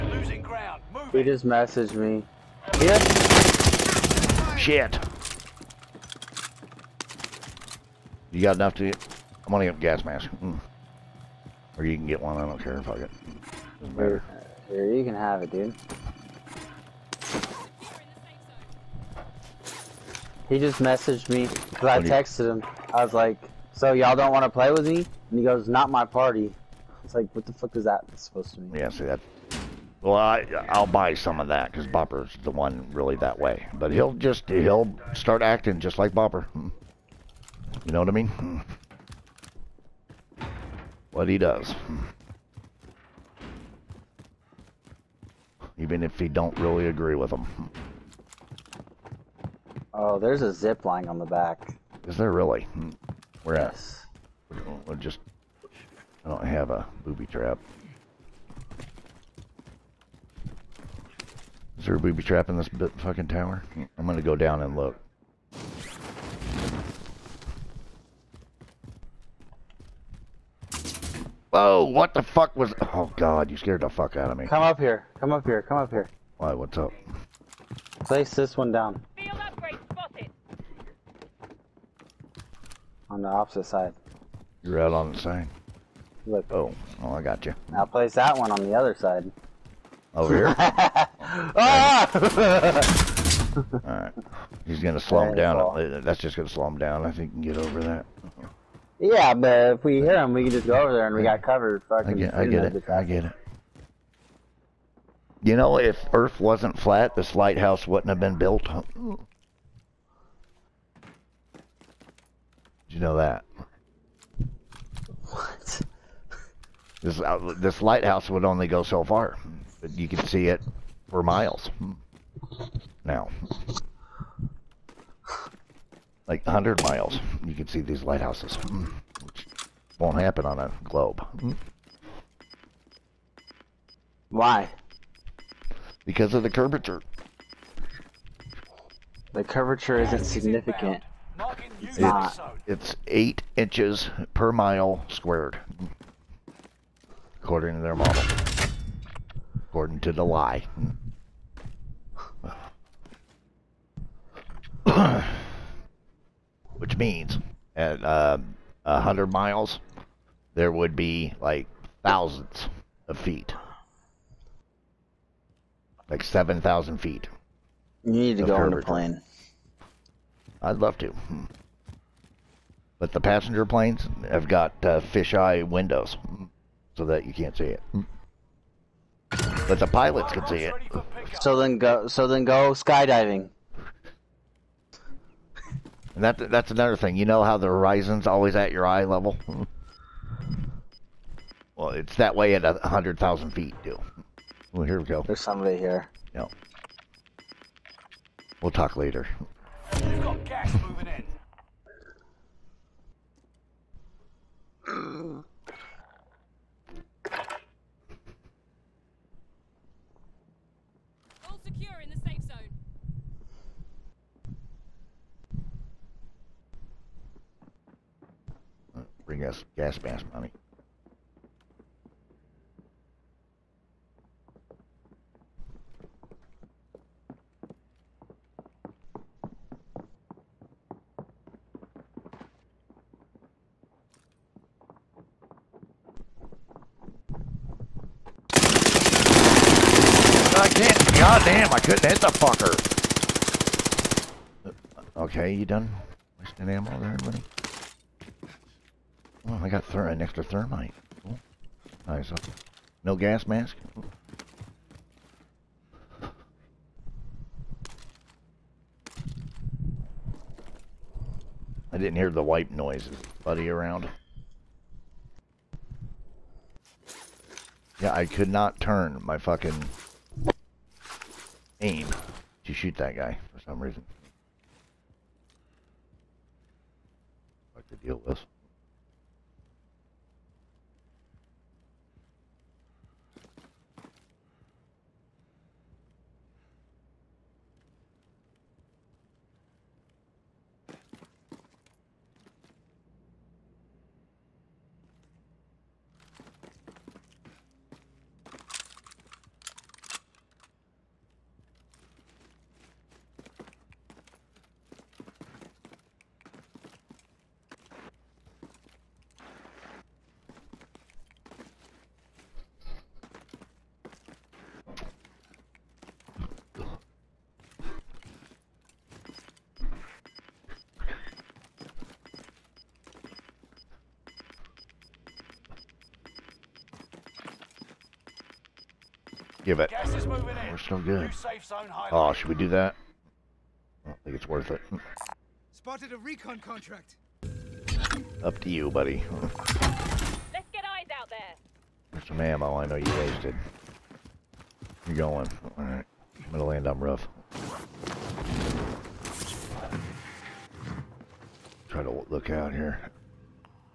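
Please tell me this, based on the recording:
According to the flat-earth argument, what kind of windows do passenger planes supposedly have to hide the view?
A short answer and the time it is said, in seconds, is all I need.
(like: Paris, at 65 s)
Fisheye windows, at 175 s.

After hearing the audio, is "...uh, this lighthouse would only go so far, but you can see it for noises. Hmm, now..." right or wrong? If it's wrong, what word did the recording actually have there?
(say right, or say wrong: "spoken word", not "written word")
wrong: "miles", not "noises".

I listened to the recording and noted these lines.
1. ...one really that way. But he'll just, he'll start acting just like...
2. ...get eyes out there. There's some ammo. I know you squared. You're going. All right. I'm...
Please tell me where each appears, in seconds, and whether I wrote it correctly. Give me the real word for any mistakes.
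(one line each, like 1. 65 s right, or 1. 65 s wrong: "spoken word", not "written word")
1. 32 s right
2. 340 s wrong: "wasted", not "squared".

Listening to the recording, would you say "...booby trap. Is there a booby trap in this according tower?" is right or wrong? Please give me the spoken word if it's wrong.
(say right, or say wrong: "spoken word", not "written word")
wrong: "fucking", not "according".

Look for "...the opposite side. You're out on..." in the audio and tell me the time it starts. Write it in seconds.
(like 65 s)
83 s.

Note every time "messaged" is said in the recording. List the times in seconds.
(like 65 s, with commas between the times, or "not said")
1 s, 20 s.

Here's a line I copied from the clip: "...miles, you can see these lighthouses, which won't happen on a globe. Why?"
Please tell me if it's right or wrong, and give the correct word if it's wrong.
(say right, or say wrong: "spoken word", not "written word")
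right.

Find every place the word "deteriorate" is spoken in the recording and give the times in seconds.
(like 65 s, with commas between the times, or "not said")
not said.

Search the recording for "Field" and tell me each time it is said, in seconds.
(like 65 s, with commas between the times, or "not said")
79 s.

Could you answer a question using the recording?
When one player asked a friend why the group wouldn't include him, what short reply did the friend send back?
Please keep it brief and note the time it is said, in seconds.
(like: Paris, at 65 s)
Not my party, at 25 s.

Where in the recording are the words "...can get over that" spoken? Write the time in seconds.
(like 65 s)
97 s.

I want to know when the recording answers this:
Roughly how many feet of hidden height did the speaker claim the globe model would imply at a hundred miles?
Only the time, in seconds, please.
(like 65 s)
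166 s.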